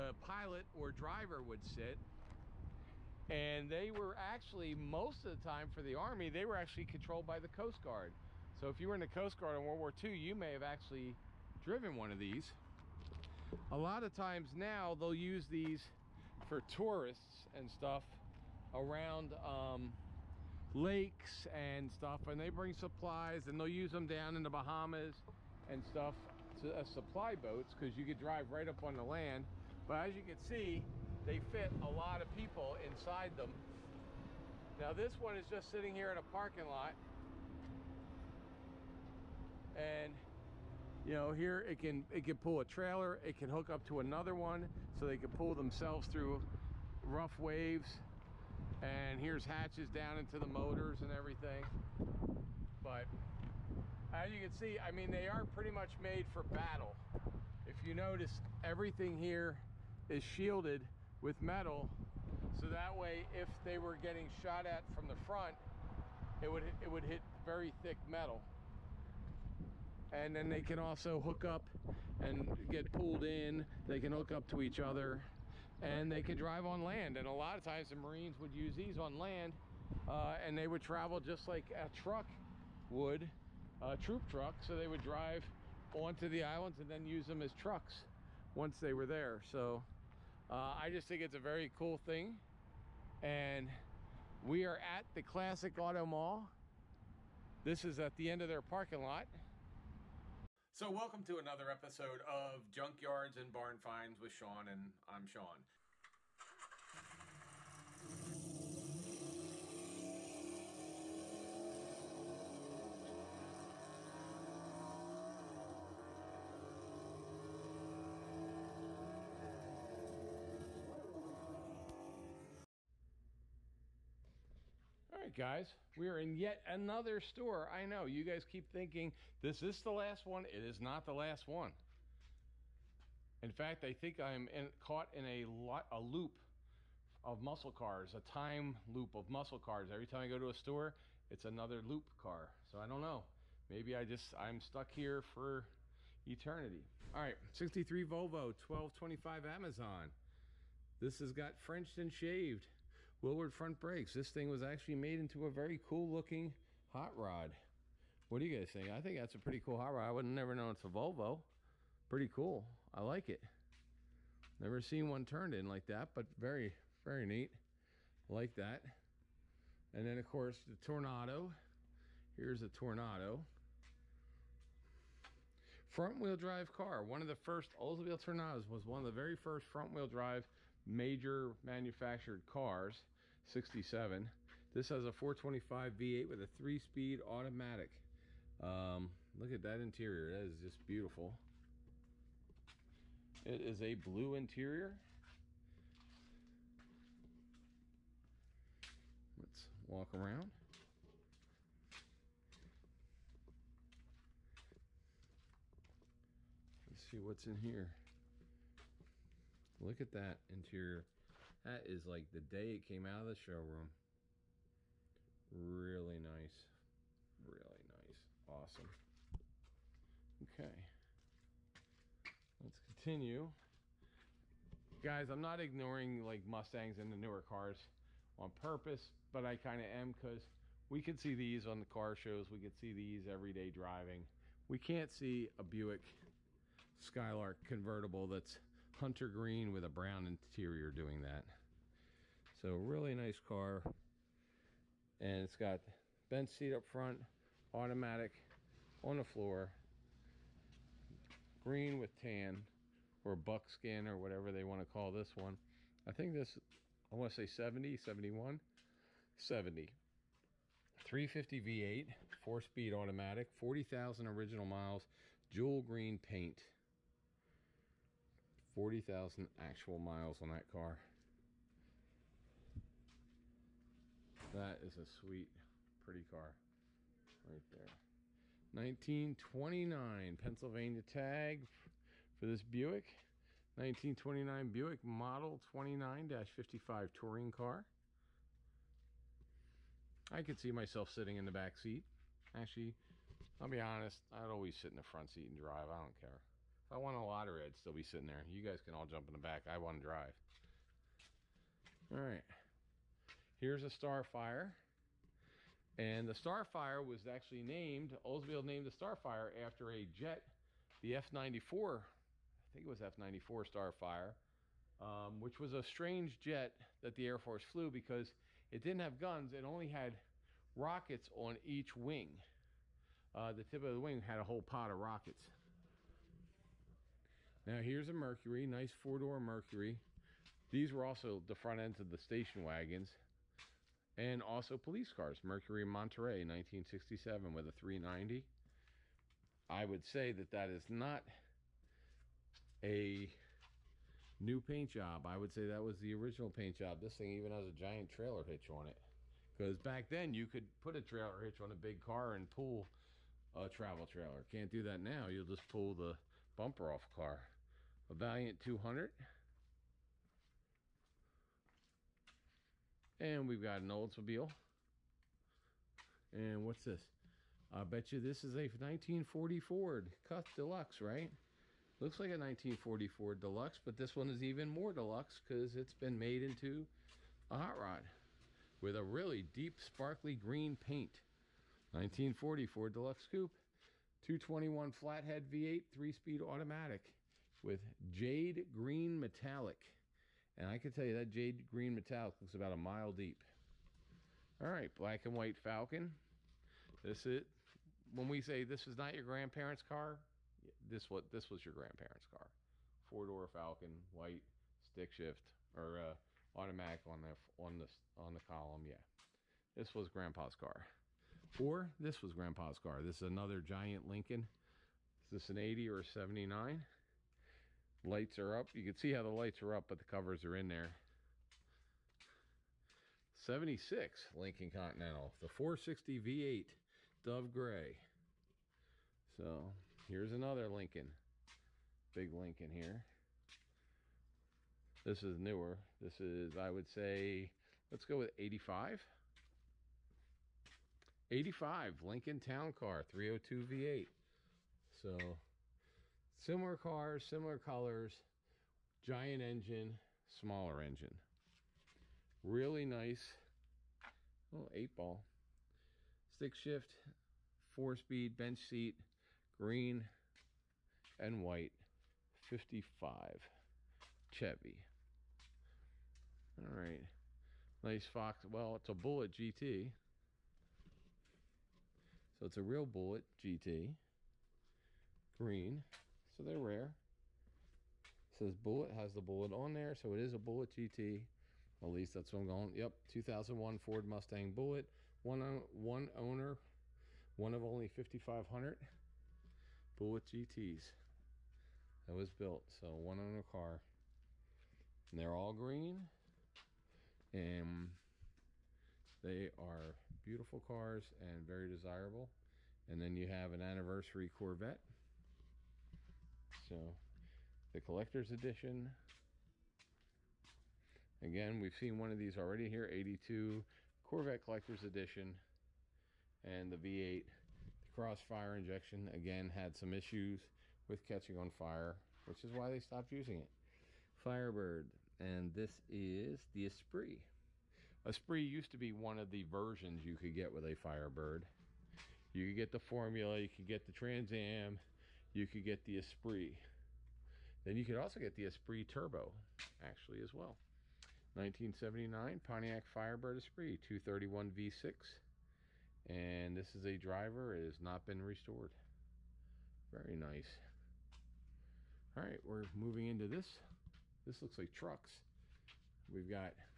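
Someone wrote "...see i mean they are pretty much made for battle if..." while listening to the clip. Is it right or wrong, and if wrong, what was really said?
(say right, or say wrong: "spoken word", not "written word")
right.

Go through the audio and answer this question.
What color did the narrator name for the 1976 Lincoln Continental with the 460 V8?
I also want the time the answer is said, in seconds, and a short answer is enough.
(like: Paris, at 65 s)
Dove Gray, at 427 s.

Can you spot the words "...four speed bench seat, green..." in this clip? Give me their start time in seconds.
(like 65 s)
457 s.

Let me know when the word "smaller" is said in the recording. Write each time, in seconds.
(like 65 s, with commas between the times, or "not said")
450 s.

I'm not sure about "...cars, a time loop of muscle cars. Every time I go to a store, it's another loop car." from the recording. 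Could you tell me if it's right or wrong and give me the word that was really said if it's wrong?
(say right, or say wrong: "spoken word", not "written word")
right.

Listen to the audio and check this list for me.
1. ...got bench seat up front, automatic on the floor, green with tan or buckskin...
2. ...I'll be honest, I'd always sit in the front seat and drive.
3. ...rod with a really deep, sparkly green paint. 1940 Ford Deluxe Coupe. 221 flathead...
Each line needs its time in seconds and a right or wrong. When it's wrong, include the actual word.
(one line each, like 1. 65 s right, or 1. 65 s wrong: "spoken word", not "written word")
1. 245 s right
2. 293 s right
3. 377 s right.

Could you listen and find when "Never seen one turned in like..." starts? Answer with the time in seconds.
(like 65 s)
164 s.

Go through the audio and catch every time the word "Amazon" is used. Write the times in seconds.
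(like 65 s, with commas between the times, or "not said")
149 s.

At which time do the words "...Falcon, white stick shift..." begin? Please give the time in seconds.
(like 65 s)
403 s.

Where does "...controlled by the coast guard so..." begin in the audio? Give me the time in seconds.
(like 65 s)
6 s.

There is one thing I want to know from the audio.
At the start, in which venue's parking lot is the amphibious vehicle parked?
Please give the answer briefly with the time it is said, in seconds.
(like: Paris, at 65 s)
Classic Auto Mall, at 95 s.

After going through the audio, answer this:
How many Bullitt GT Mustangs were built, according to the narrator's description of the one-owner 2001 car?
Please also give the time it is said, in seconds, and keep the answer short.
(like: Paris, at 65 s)
5,500, at 487 s.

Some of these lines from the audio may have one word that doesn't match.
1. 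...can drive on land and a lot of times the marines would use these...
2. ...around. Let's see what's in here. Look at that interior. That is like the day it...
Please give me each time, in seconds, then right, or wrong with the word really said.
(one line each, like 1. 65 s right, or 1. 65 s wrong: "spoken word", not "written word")
1. 76 s right
2. 200 s right.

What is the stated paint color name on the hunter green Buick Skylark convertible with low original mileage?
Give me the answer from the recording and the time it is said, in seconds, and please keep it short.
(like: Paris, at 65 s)
jewel green, at 265 s.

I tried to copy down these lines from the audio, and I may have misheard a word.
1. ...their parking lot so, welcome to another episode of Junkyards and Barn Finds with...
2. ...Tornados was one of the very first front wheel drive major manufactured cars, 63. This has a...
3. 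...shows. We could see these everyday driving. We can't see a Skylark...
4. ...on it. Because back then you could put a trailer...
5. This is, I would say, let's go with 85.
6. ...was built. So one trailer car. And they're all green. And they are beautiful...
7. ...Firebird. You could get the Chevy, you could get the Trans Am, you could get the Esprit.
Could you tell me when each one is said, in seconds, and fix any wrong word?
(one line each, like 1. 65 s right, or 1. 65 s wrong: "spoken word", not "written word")
1. 98 s right
2. 178 s wrong: "67", not "63"
3. 232 s wrong: "Buick", not "Skylark"
4. 348 s right
5. 436 s right
6. 492 s wrong: "owner", not "trailer"
7. 530 s wrong: "Formula", not "Chevy".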